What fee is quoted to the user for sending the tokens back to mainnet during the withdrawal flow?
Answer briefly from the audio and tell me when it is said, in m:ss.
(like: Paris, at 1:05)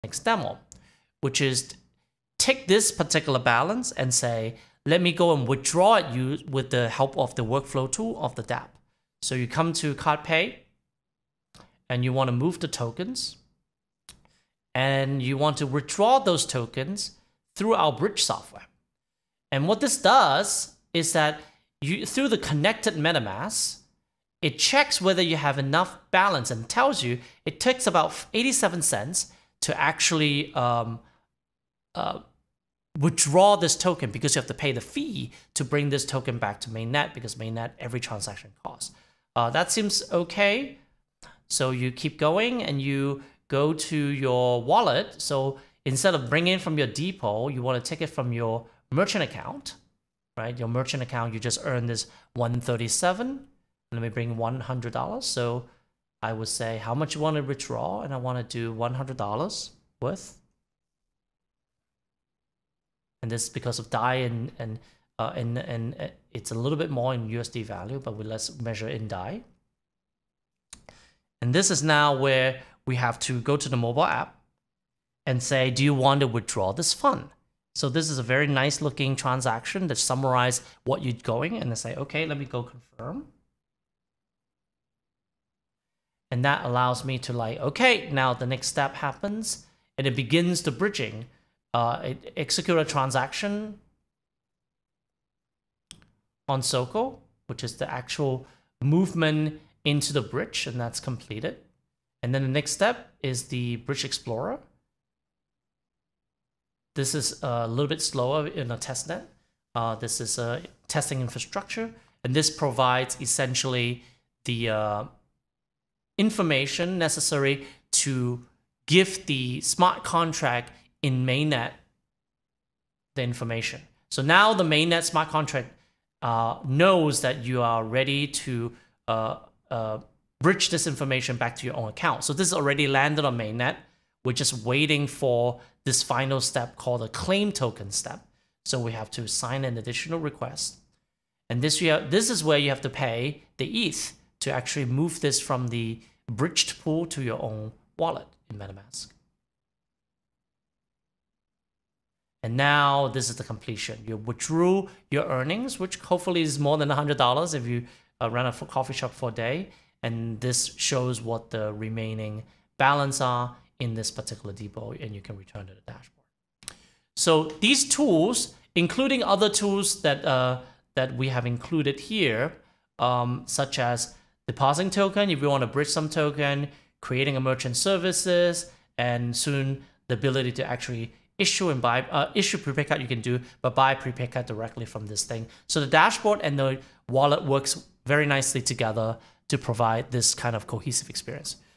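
87 cents, at 0:28.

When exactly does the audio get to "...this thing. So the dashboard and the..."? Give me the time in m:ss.
3:05.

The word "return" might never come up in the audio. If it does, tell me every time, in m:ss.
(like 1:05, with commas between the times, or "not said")
2:45.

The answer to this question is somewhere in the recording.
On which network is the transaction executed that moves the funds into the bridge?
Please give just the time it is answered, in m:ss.
1:36.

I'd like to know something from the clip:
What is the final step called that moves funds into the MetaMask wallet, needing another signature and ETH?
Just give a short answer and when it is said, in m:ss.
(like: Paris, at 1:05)
claim token step, at 2:17.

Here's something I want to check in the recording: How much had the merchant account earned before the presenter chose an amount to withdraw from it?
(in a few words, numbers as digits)
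137.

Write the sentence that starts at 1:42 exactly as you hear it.
And then the next step is the Bridge Explorer.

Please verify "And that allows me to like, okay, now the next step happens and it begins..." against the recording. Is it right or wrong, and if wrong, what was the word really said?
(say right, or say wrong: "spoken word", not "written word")
right.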